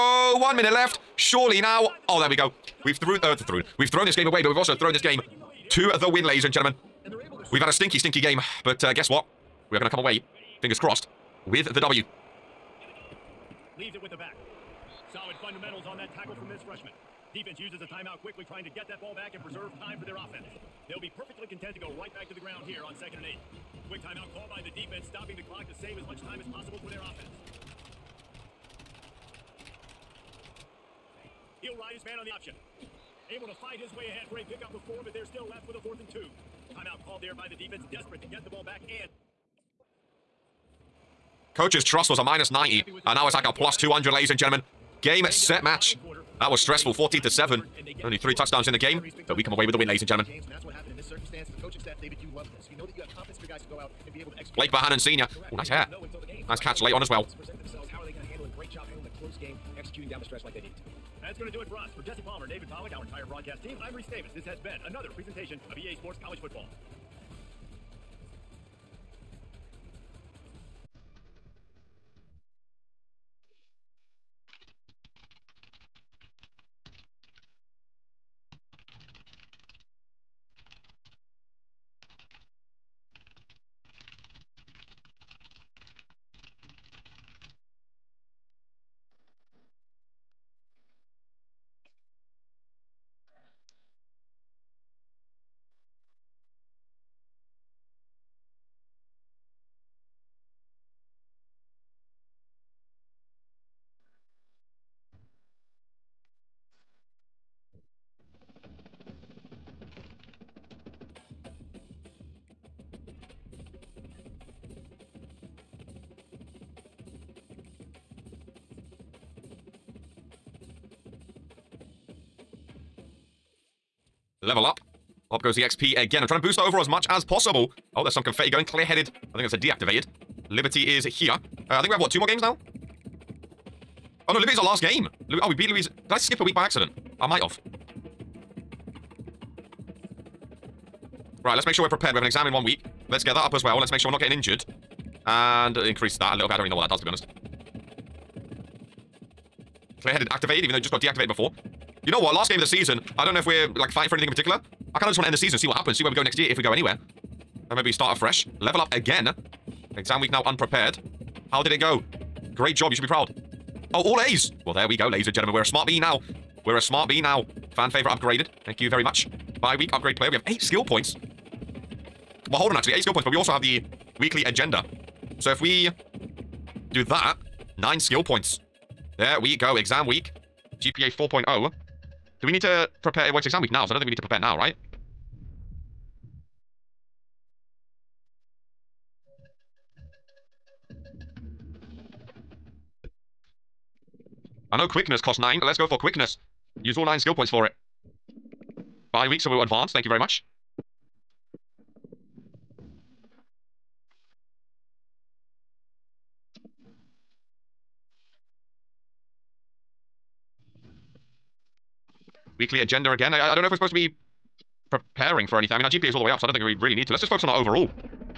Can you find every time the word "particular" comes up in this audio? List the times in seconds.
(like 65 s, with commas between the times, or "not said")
154 s.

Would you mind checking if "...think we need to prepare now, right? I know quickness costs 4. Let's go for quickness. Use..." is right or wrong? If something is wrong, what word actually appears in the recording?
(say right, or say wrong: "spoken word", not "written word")
wrong: "9", not "4".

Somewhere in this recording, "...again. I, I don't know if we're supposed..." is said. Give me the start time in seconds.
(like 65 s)
213 s.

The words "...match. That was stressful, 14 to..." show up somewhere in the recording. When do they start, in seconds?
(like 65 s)
45 s.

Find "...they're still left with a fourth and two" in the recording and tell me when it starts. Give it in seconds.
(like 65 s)
35 s.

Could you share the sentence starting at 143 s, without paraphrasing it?
Let's get that up as well.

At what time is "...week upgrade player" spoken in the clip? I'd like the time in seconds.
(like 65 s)
169 s.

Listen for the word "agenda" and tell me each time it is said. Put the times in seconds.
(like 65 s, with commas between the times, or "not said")
174 s, 212 s.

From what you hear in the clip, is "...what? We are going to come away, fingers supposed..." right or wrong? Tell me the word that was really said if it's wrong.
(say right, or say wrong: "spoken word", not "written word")
wrong: "crossed", not "supposed".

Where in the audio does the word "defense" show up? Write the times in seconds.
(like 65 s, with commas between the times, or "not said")
17 s, 24 s, 37 s.